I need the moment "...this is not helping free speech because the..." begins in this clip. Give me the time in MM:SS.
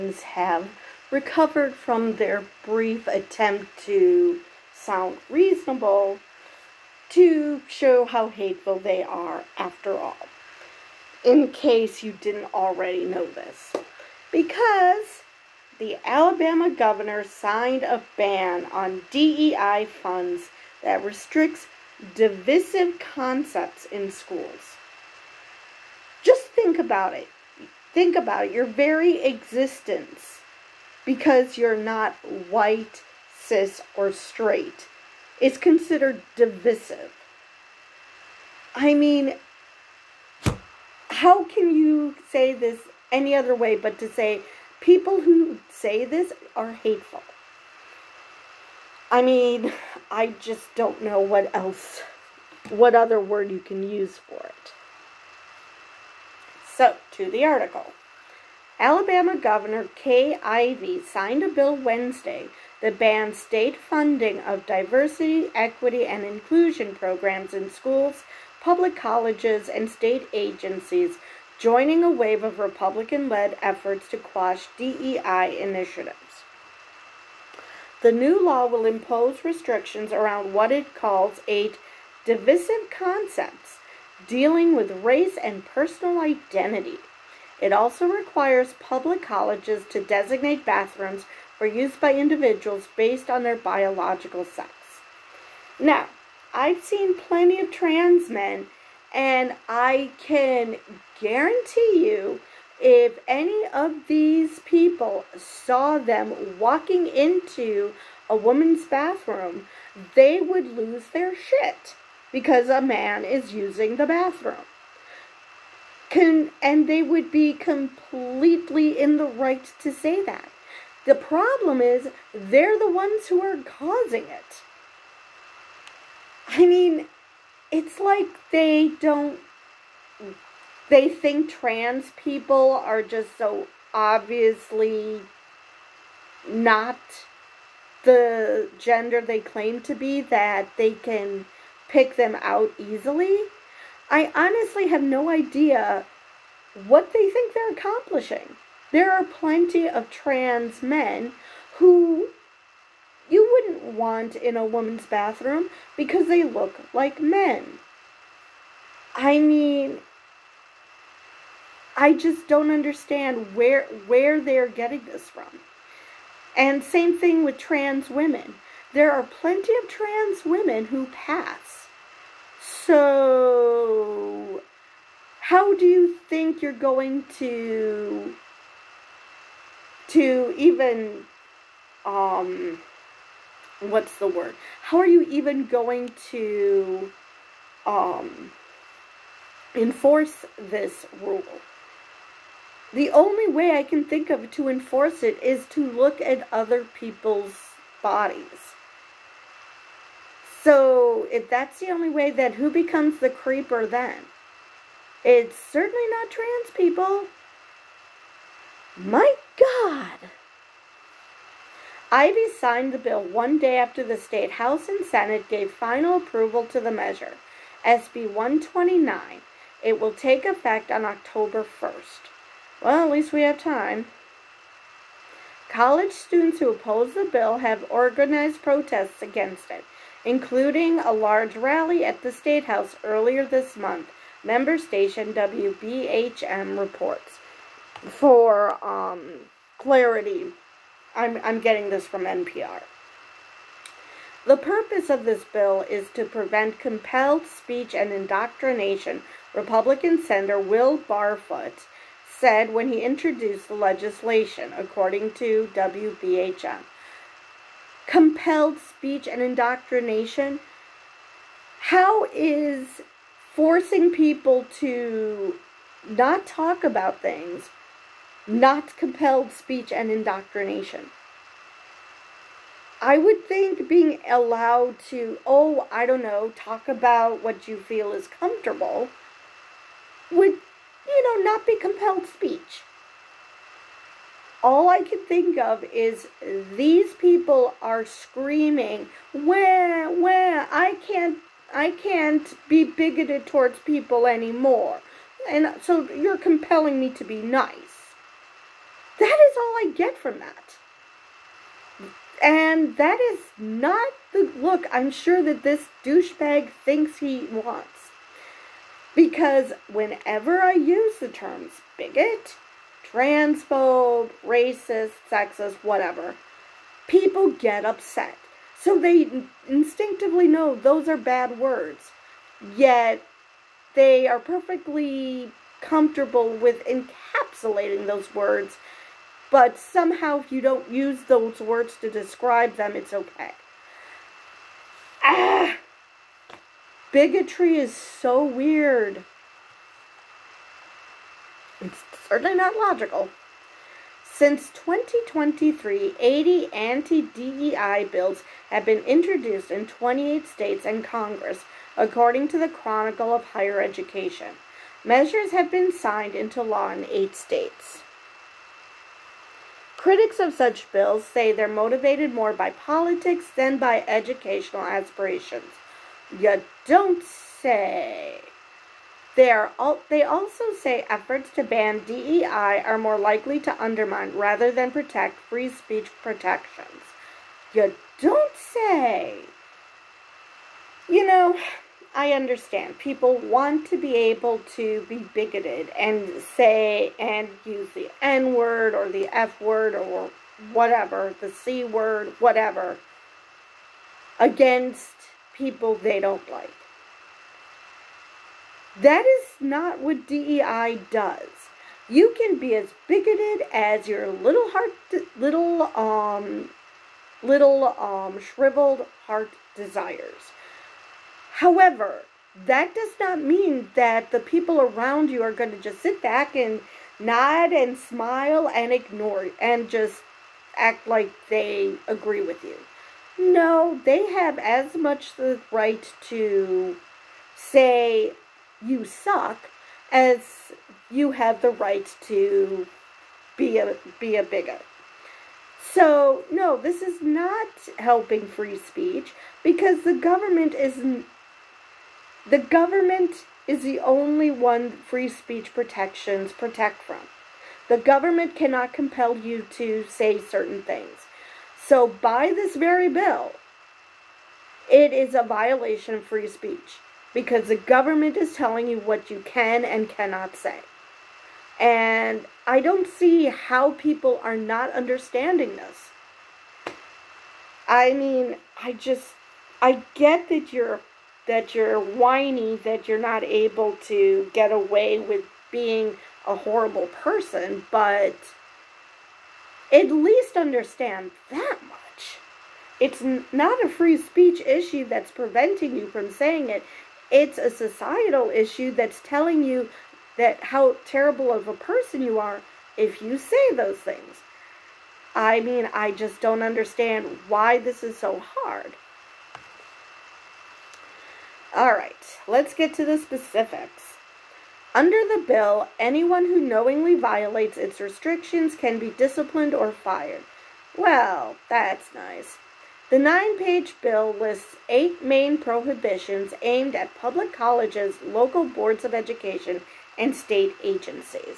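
07:16.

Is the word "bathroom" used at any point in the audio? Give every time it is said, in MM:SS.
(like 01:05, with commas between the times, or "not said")
01:30, 01:48, 01:54, 02:35.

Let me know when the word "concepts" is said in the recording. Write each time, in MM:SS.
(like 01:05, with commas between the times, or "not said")
00:22, 01:22.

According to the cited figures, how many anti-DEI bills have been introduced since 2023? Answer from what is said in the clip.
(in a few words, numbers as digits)
80.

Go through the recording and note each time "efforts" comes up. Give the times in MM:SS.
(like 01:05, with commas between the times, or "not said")
01:13, 06:11.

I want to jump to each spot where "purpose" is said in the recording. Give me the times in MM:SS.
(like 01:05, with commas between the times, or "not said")
04:04.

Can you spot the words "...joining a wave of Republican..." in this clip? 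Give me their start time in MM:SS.
01:11.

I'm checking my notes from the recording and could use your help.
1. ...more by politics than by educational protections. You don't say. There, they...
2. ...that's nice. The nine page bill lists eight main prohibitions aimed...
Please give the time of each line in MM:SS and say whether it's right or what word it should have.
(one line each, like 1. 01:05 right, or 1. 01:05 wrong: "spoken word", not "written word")
1. 06:02 wrong: "aspirations", not "protections"
2. 08:31 right.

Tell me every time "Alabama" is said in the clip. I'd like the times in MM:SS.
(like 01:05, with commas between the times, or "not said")
00:16, 00:58.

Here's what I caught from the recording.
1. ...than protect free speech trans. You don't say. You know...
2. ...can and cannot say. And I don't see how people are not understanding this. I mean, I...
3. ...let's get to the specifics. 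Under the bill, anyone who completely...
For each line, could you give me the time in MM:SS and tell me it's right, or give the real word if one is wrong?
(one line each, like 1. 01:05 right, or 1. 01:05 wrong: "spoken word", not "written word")
1. 06:14 wrong: "protections", not "trans"
2. 07:39 right
3. 08:22 wrong: "knowingly", not "completely".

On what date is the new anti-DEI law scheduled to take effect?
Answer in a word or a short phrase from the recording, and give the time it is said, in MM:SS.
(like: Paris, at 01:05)
October 1st, at 03:41.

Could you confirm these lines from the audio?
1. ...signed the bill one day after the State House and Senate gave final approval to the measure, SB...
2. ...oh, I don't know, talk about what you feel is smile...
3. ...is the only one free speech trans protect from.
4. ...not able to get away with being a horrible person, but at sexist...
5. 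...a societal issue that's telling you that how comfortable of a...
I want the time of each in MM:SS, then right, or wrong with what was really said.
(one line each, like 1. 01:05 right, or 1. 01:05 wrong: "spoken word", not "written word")
1. 03:32 right
2. 04:35 wrong: "comfortable", not "smile"
3. 07:23 wrong: "protections", not "trans"
4. 07:53 wrong: "least", not "sexist"
5. 08:07 wrong: "terrible", not "comfortable".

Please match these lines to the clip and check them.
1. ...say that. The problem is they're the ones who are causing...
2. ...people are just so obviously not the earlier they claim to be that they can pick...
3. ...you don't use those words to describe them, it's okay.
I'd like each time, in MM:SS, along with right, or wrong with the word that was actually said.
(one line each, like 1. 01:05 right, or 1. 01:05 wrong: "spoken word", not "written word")
1. 01:59 right
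2. 02:12 wrong: "gender", not "earlier"
3. 05:30 right.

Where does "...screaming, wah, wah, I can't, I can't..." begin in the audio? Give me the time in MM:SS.
04:48.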